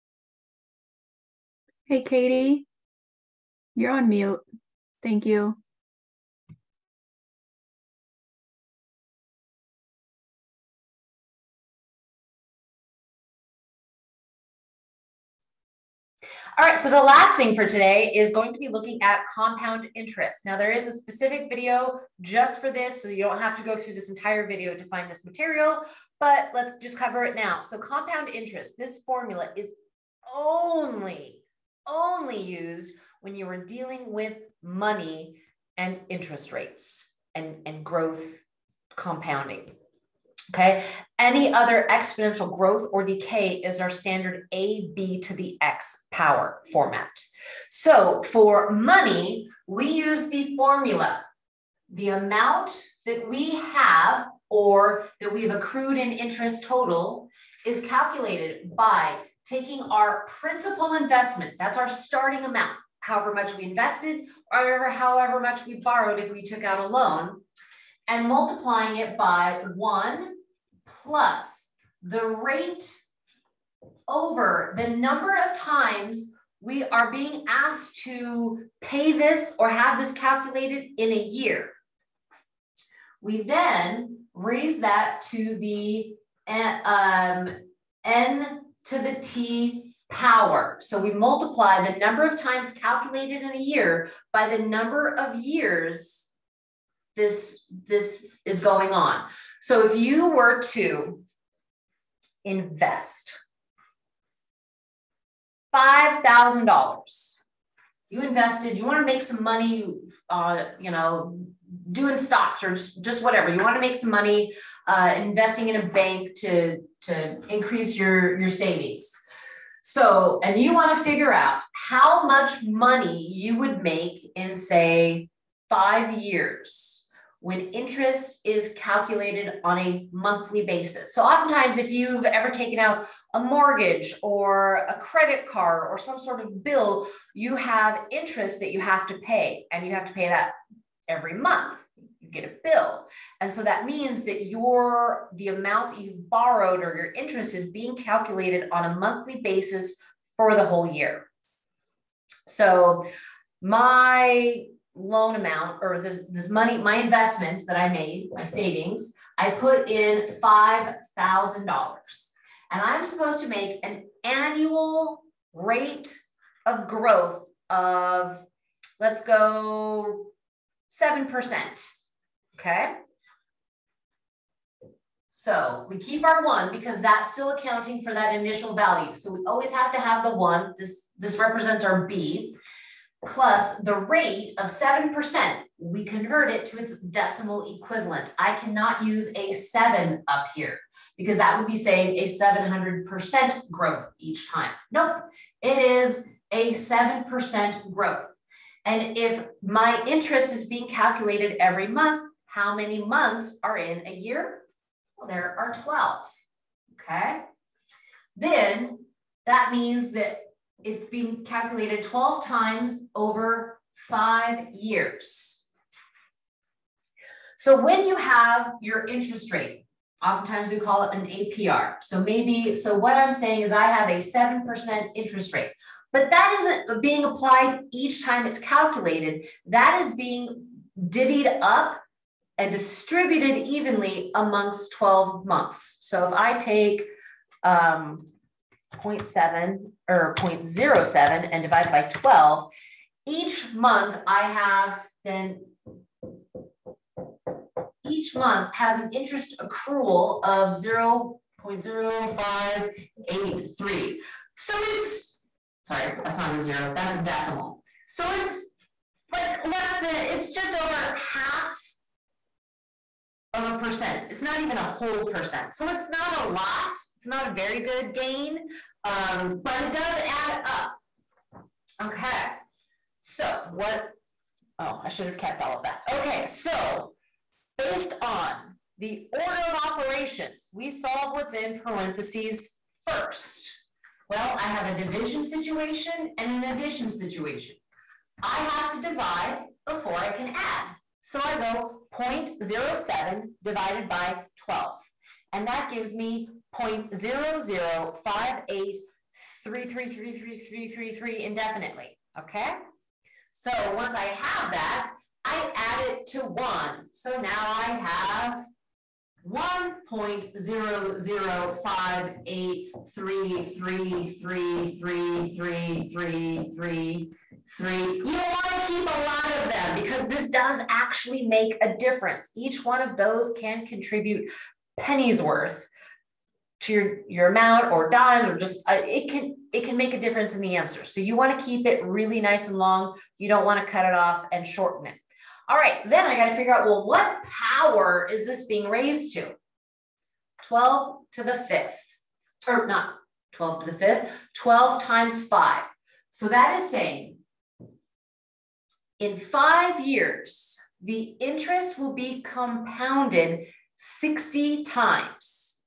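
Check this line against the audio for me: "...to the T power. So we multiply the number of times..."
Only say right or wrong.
right.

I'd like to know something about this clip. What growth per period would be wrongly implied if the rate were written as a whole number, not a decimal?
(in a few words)
700%.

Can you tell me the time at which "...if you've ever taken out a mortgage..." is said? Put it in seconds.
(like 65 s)
131 s.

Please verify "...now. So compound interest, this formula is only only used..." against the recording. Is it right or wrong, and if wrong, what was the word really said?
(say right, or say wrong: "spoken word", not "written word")
right.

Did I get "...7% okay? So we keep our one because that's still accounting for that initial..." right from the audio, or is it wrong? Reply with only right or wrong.
right.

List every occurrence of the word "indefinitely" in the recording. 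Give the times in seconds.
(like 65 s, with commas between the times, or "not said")
301 s.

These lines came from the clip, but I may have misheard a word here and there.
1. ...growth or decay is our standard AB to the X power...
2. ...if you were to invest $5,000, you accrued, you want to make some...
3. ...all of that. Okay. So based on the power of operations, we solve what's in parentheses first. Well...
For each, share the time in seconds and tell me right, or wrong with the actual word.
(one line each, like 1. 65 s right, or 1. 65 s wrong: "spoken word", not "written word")
1. 42 s right
2. 99 s wrong: "invested", not "accrued"
3. 275 s wrong: "order", not "power".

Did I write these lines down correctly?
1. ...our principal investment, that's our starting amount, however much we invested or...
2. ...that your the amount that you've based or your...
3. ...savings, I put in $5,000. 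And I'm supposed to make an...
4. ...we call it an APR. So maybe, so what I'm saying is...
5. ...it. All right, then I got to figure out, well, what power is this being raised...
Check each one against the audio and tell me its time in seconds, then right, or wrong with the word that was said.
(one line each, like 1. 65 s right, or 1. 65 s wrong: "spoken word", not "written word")
1. 59 s right
2. 144 s wrong: "borrowed", not "based"
3. 158 s right
4. 220 s right
5. 335 s right.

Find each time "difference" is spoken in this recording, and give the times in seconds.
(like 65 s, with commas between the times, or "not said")
321 s, 330 s.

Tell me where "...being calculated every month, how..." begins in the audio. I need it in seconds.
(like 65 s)
200 s.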